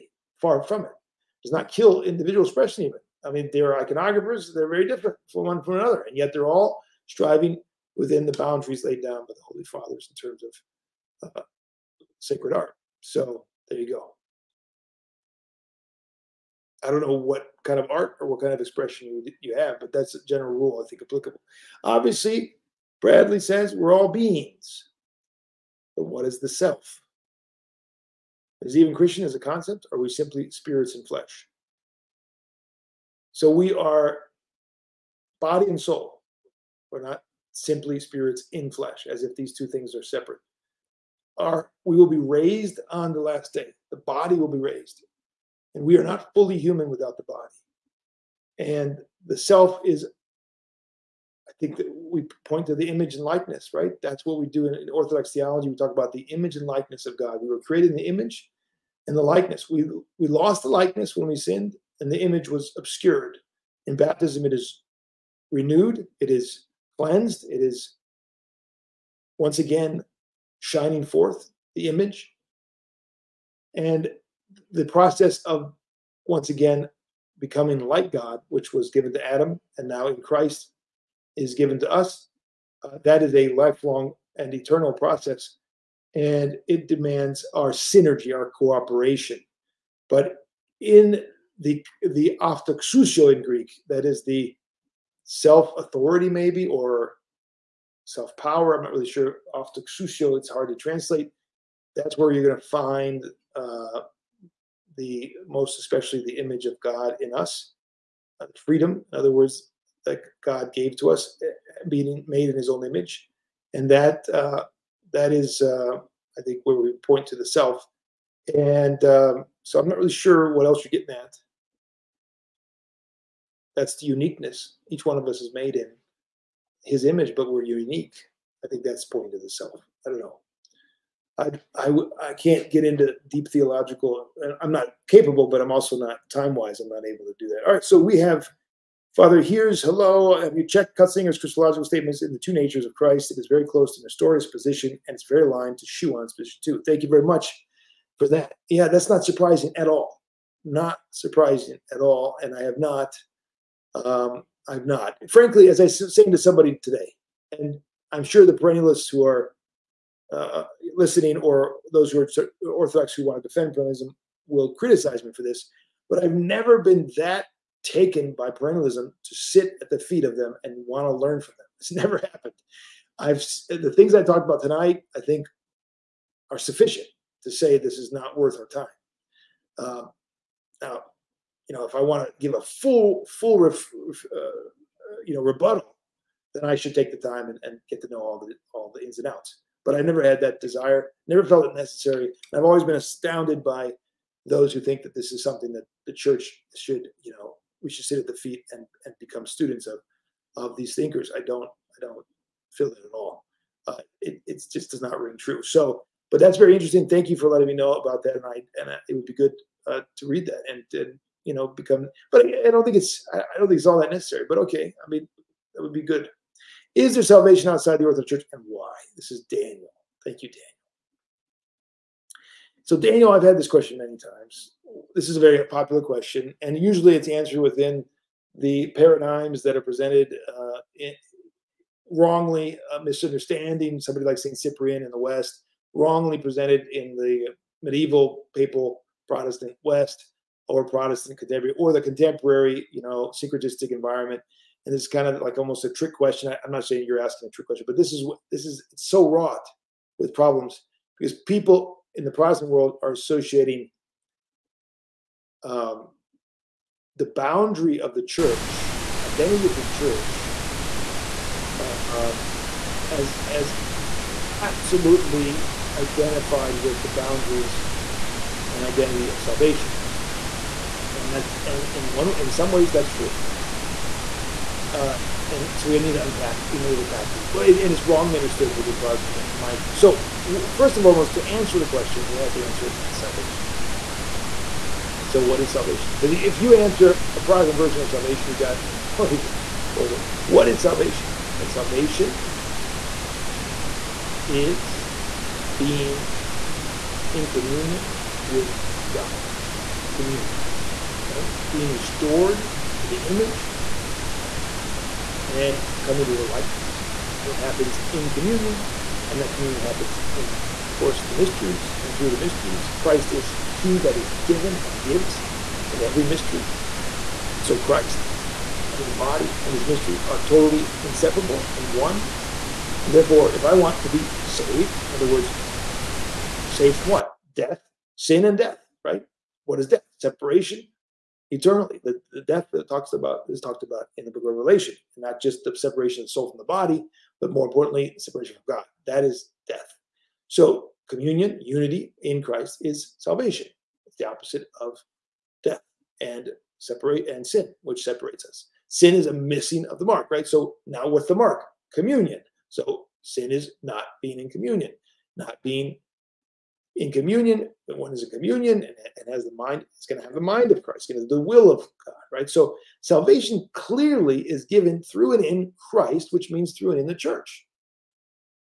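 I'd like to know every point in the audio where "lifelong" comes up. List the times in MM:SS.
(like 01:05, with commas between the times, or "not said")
01:23.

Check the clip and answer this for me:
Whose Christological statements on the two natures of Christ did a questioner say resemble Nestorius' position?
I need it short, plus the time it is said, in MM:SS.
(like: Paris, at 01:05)
Cutsinger, at 02:20.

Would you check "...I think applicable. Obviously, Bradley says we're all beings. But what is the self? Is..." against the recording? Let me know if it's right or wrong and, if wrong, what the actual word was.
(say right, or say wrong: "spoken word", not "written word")
right.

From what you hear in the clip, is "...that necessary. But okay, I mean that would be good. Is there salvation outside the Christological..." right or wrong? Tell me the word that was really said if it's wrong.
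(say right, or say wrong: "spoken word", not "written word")
wrong: "Orthodox", not "Christological".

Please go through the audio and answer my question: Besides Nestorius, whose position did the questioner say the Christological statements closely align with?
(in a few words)
Schuon.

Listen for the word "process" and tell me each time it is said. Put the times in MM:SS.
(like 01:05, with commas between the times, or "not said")
01:14, 01:24.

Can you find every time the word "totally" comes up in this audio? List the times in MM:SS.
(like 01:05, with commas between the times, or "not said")
04:49, 05:20.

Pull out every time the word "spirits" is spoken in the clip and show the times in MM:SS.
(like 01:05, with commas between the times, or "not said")
00:30, 00:37.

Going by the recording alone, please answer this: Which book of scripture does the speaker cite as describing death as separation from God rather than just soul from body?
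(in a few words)
Book of Revelation.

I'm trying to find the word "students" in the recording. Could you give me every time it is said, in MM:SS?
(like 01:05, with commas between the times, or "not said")
03:19.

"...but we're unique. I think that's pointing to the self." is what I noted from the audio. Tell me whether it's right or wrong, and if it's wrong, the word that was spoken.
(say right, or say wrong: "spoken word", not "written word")
right.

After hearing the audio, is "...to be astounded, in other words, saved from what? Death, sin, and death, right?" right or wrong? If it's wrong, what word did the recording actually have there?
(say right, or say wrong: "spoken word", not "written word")
wrong: "saved", not "astounded".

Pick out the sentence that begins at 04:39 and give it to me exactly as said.
So, first and foremost, to answer the question, we have to answer what is salvation.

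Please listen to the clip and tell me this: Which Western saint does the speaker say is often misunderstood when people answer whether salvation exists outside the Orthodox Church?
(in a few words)
Saint Cyprian.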